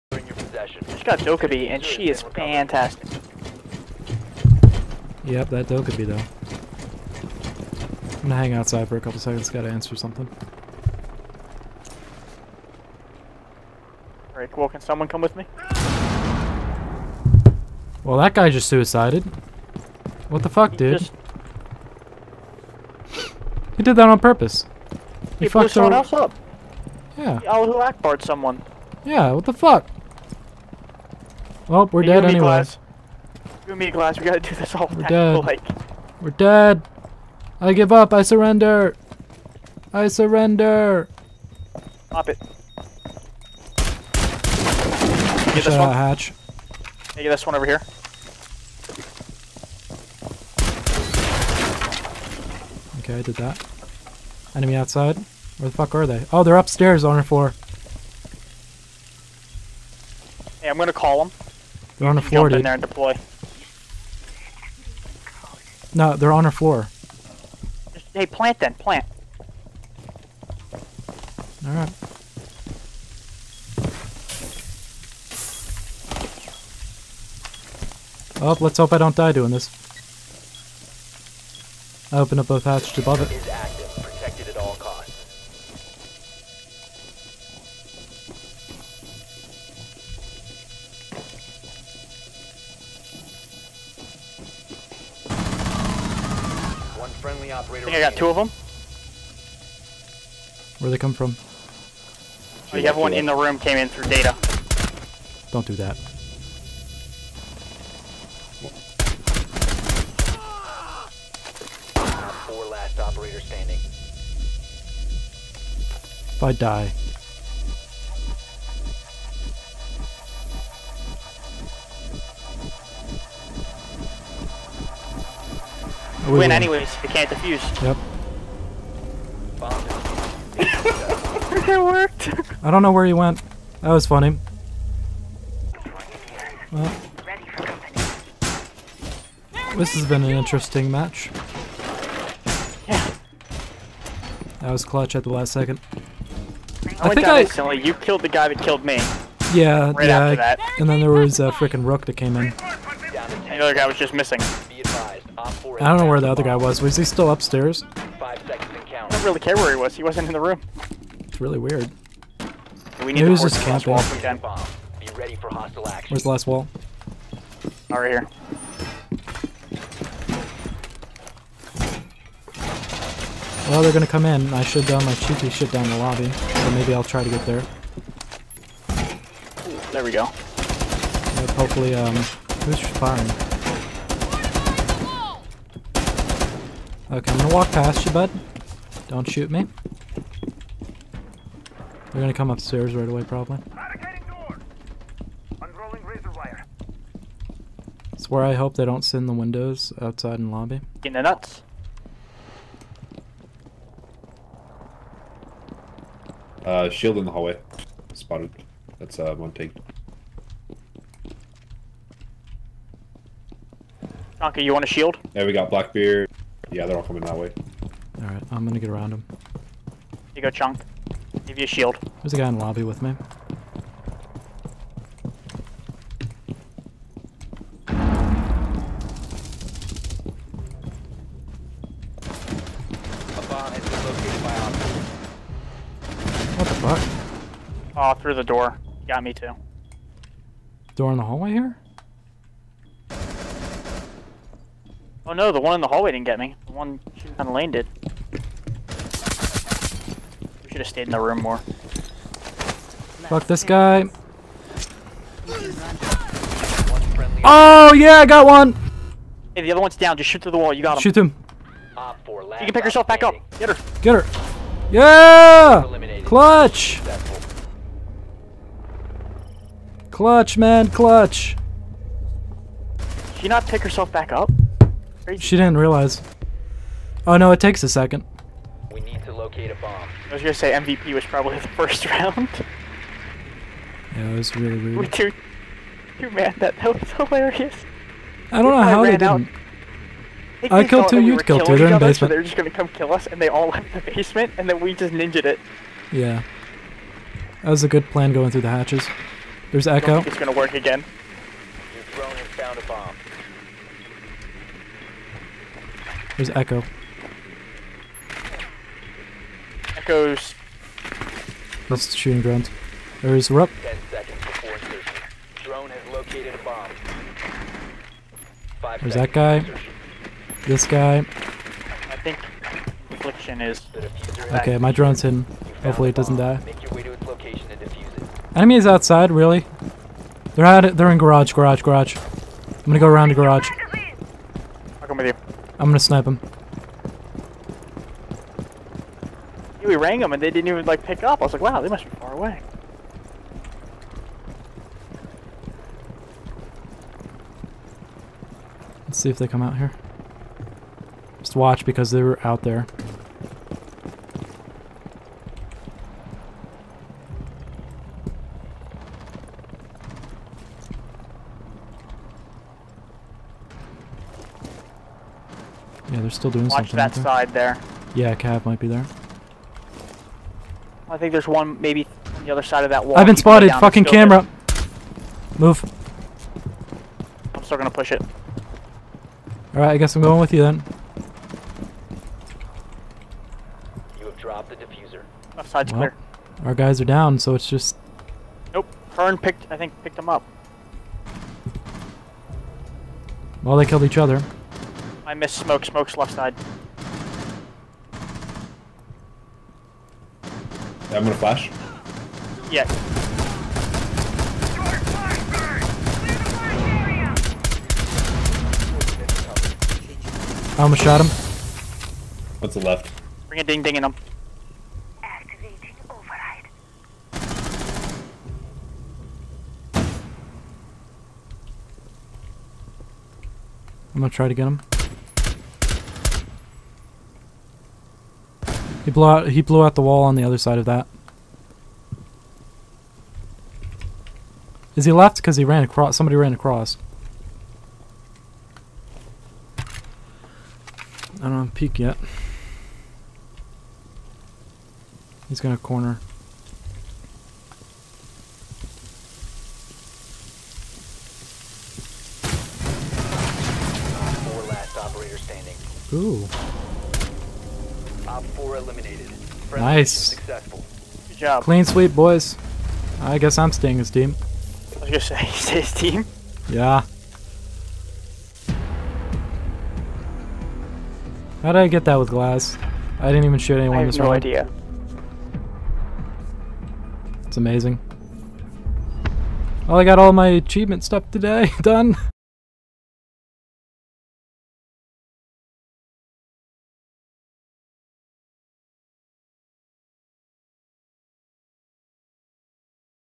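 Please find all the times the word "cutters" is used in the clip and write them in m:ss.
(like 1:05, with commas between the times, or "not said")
not said.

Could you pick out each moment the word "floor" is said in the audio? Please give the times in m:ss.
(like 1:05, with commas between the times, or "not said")
0:57, 1:02, 1:06.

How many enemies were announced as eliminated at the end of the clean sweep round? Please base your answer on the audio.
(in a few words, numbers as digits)
4.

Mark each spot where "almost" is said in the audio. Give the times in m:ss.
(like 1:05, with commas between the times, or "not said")
6:50.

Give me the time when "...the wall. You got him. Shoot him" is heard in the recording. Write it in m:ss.
4:20.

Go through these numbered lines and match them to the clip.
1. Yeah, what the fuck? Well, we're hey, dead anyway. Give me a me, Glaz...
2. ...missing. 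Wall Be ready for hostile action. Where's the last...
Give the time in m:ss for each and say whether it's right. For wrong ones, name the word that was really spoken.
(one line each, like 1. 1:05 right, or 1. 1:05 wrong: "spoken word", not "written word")
1. 0:29 right
2. 2:43 wrong: "camping", not "missing".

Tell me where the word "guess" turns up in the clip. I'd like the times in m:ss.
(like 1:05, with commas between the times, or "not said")
6:19, 7:43.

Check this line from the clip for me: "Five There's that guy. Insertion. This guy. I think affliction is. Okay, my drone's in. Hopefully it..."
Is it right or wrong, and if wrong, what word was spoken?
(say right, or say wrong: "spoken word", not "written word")
right.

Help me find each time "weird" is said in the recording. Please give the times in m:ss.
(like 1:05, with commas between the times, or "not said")
2:41, 4:44.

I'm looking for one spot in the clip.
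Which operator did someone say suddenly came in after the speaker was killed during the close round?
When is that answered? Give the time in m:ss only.
2:31.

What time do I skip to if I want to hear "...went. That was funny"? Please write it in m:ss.
2:13.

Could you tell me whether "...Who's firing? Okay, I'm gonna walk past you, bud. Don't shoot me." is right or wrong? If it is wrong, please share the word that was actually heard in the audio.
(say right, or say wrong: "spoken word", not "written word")
right.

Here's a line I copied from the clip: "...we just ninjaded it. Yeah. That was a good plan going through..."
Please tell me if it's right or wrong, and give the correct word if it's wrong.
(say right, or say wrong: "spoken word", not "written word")
right.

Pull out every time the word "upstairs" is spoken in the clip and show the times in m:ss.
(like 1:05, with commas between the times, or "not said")
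0:56, 2:37, 3:12.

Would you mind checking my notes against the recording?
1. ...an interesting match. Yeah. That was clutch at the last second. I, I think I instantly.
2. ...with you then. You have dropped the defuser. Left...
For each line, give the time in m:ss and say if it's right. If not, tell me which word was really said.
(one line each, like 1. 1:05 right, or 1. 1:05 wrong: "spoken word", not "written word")
1. 2:20 right
2. 6:20 right.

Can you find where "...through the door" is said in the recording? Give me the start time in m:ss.
3:58.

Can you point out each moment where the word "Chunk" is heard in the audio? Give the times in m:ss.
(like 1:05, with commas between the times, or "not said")
3:40.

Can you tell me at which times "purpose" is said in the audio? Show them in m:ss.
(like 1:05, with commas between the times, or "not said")
0:24.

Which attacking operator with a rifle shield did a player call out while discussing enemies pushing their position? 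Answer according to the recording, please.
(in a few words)
Blackbeard.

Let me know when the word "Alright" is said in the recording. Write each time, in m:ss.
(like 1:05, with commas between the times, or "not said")
0:14, 1:11, 3:38.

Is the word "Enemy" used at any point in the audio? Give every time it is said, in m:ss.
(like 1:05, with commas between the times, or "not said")
0:54, 5:28.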